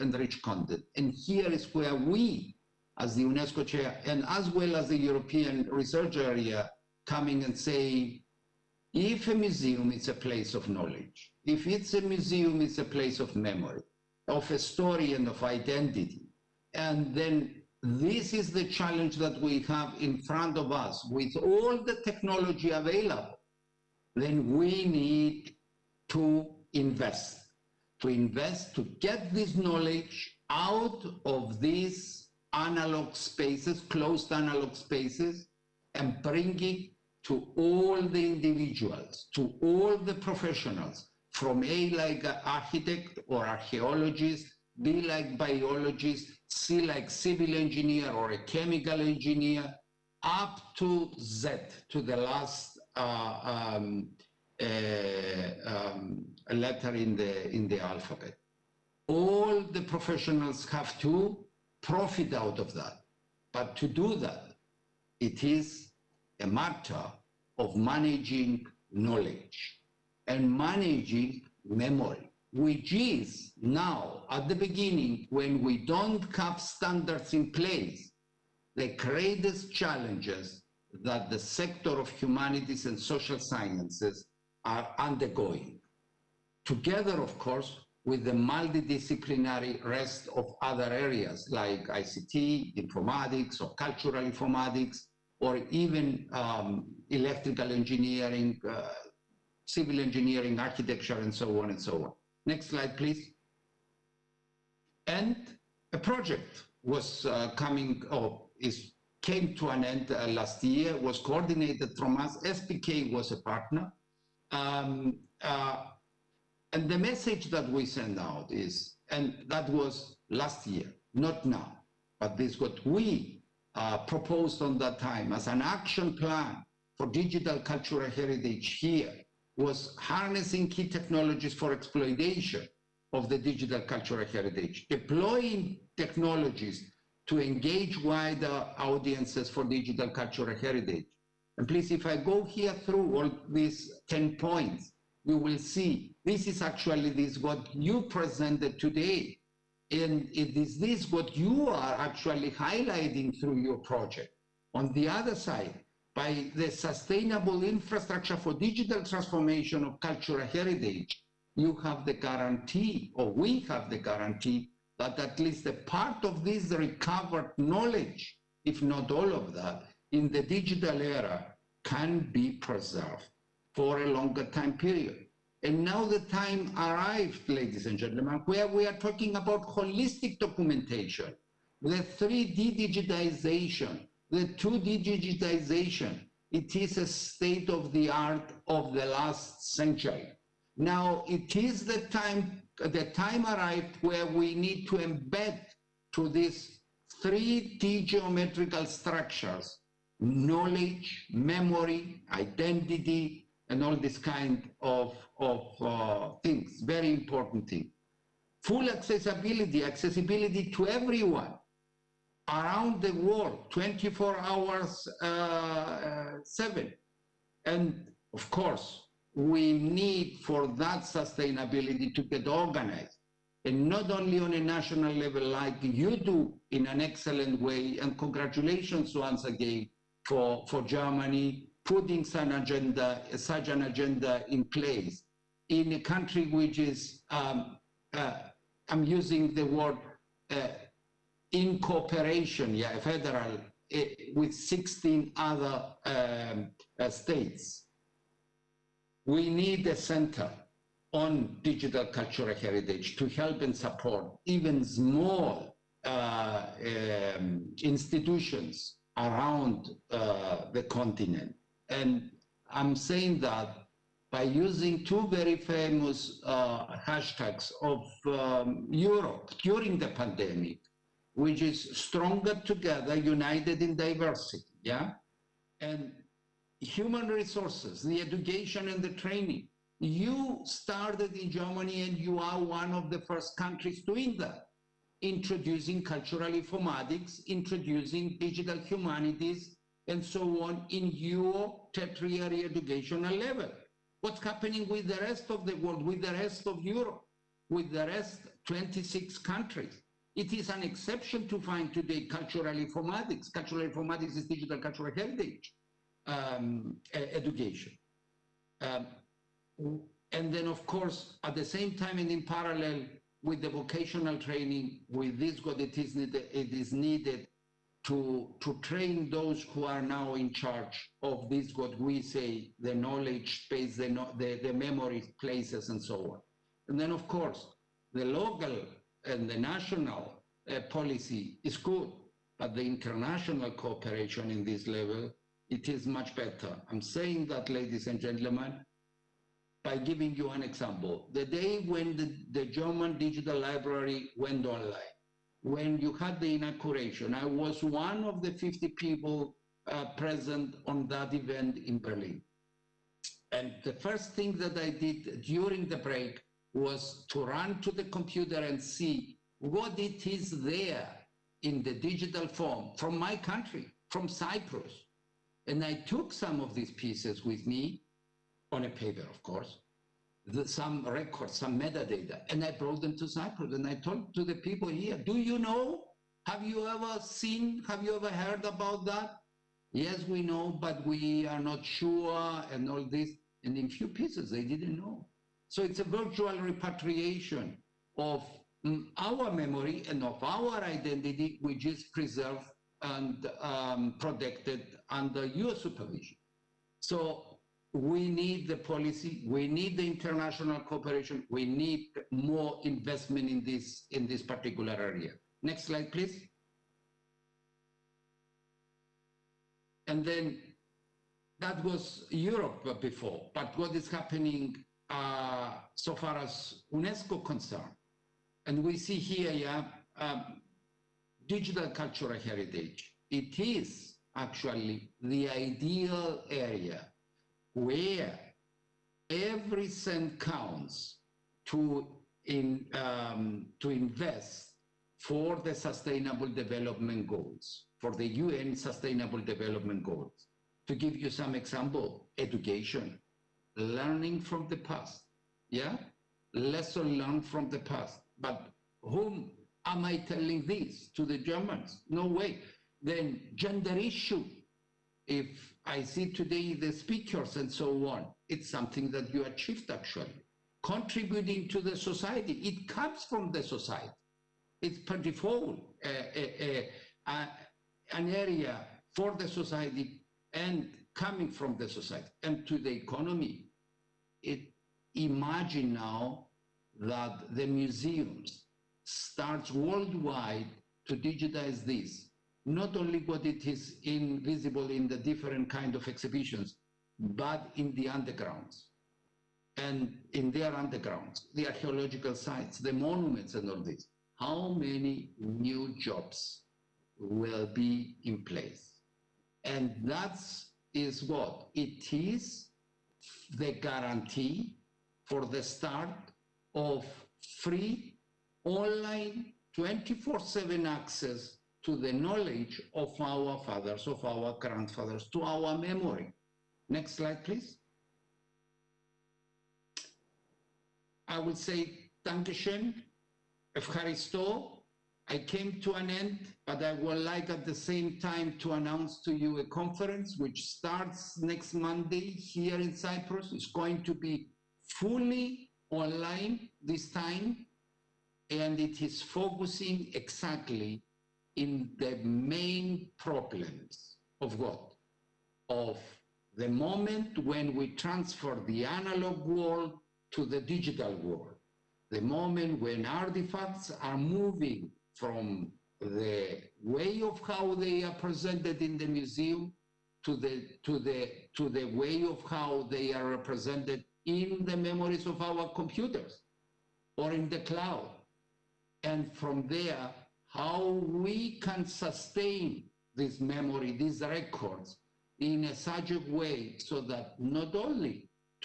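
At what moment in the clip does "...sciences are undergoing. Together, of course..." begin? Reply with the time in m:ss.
1:23.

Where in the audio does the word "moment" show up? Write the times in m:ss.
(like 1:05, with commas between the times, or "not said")
9:06, 9:12.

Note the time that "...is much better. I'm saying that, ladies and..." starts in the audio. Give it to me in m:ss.
5:35.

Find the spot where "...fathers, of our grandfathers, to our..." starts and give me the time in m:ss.
8:33.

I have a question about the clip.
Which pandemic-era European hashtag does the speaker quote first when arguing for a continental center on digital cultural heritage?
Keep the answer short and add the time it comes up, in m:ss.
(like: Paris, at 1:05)
stronger together, at 4:31.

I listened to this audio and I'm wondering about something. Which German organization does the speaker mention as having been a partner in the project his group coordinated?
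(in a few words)
SPK.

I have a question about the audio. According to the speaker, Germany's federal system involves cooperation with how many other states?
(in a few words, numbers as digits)
16.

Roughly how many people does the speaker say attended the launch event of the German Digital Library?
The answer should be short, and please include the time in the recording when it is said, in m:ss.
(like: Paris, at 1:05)
50, at 5:48.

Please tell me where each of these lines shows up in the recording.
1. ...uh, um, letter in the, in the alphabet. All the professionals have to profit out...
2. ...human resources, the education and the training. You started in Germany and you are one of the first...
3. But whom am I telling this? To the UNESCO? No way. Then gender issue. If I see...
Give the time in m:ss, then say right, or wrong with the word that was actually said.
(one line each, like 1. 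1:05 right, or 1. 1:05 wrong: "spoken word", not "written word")
1. 0:54 right
2. 4:36 right
3. 7:28 wrong: "Germans", not "UNESCO".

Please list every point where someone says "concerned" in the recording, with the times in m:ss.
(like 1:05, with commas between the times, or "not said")
6:57.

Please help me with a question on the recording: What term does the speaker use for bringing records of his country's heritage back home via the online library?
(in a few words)
virtual repatriation.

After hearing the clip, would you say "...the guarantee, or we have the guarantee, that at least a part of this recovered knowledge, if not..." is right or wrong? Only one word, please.
right.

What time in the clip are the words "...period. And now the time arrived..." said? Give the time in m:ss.
2:54.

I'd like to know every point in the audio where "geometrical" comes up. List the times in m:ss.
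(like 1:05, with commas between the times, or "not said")
3:18.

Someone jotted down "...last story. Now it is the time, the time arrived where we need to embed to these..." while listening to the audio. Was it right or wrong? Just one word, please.
wrong.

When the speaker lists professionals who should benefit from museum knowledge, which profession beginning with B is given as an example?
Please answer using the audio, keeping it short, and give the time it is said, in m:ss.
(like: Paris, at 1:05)
biologist, at 0:45.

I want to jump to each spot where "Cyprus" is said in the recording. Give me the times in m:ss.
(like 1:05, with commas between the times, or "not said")
6:04, 6:13, 8:52.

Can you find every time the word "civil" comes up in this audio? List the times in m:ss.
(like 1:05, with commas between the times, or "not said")
0:47, 1:39.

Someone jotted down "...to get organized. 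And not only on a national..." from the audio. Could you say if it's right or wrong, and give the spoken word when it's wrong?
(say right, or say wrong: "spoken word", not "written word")
right.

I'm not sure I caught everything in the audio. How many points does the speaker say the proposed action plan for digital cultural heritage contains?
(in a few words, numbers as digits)
10.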